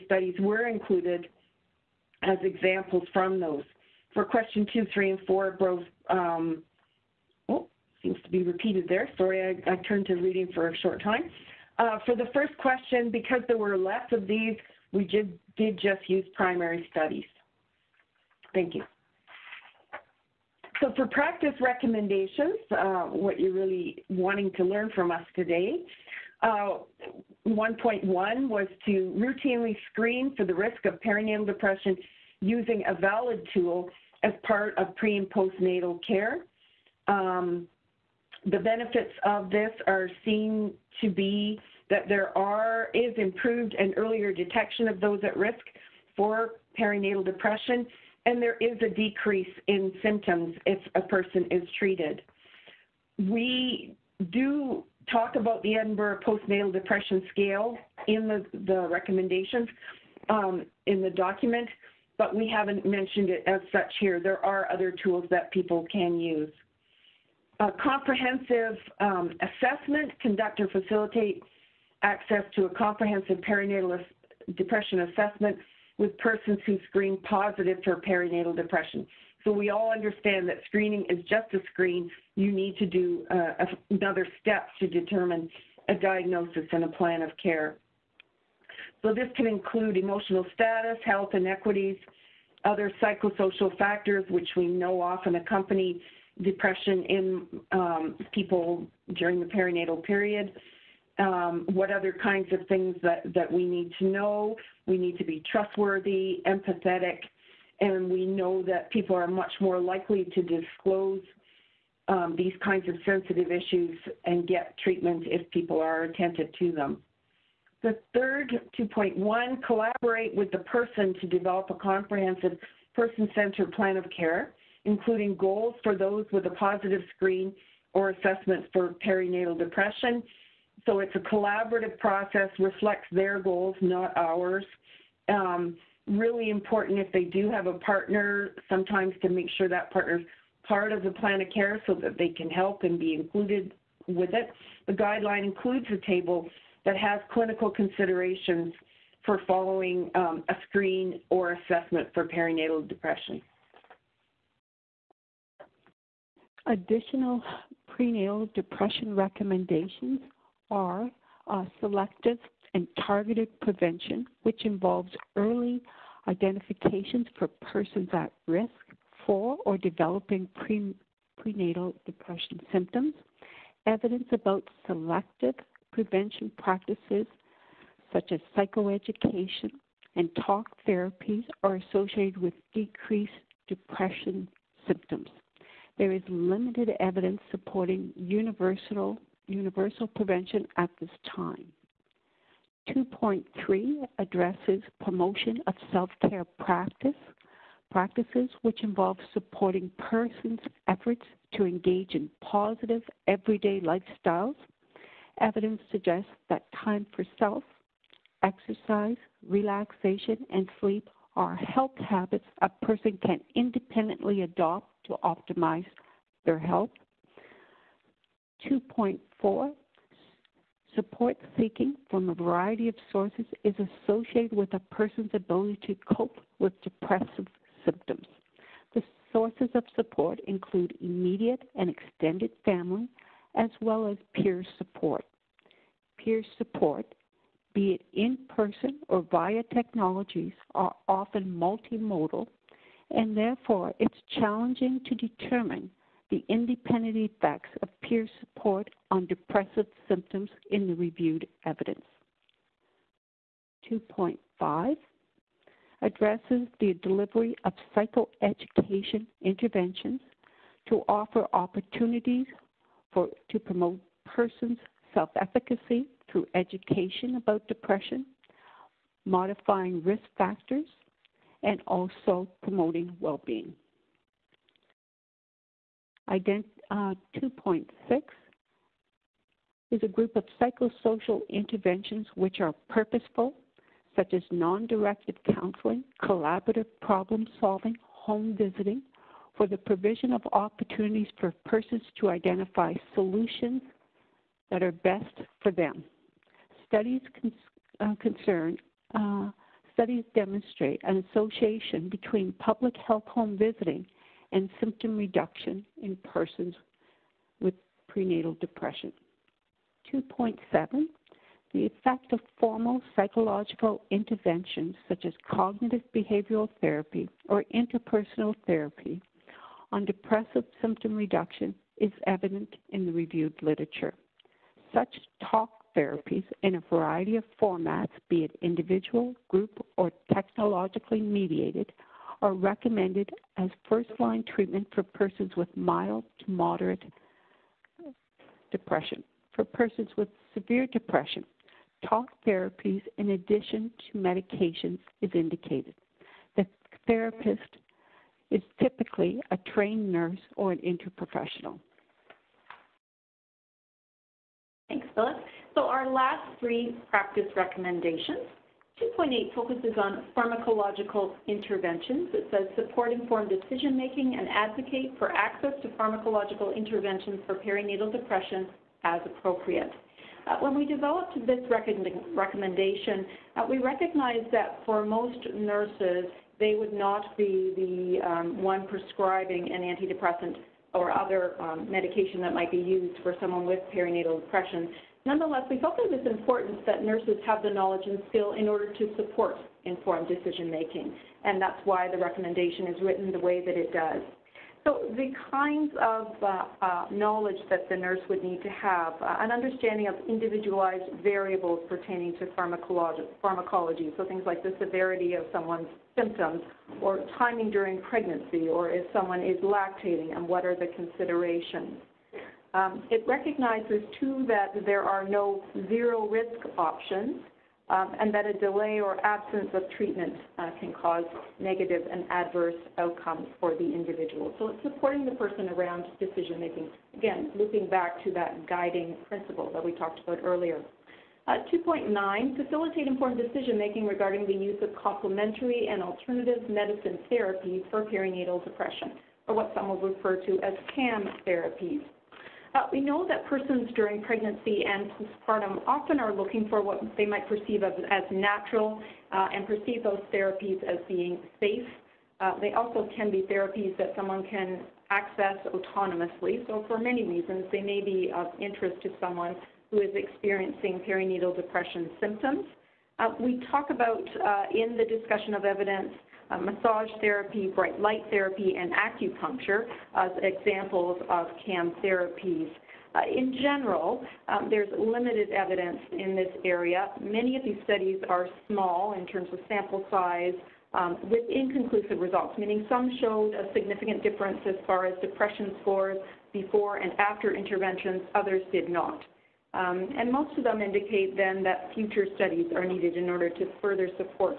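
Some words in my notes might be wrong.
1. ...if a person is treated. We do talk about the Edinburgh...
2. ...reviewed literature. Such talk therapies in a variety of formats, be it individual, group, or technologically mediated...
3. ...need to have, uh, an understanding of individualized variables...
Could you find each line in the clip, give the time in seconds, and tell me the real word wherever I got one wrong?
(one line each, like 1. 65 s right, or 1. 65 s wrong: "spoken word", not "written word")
1. 50 s right
2. 323 s right
3. 398 s right.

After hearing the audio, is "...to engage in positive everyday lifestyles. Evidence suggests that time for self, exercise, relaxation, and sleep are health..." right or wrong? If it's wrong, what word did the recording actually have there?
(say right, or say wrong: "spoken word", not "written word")
right.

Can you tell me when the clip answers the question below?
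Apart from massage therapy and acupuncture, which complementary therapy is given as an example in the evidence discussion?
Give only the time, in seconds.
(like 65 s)
467 s.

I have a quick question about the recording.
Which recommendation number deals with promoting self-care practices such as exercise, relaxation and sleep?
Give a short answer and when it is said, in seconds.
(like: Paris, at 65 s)
2.3, at 192 s.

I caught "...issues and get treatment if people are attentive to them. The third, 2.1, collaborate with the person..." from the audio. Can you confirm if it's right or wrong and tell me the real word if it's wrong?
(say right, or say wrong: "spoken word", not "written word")
right.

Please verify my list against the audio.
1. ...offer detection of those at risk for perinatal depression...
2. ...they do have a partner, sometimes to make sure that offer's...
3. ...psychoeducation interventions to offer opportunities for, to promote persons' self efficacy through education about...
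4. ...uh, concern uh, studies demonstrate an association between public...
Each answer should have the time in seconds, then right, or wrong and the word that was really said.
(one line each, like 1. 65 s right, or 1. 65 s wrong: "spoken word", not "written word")
1. 43 s wrong: "earlier", not "offer"
2. 137 s wrong: "partner", not "offer"
3. 257 s right
4. 297 s right.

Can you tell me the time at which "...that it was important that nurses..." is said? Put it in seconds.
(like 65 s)
385 s.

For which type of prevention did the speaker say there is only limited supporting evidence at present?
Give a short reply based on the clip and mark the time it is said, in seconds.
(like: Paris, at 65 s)
universal prevention, at 188 s.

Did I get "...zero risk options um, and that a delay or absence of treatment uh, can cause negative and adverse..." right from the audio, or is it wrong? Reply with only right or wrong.
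right.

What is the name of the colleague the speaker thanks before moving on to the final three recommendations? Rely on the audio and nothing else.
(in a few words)
Phyllis.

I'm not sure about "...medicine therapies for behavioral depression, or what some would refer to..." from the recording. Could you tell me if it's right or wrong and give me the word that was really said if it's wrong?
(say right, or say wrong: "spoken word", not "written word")
wrong: "perinatal", not "behavioral".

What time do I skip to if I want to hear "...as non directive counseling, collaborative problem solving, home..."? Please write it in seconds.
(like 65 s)
284 s.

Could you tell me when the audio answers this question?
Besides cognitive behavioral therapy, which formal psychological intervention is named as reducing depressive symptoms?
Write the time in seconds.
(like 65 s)
317 s.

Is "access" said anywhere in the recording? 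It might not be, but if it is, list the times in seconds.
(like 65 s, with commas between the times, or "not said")
72 s, 365 s, 455 s.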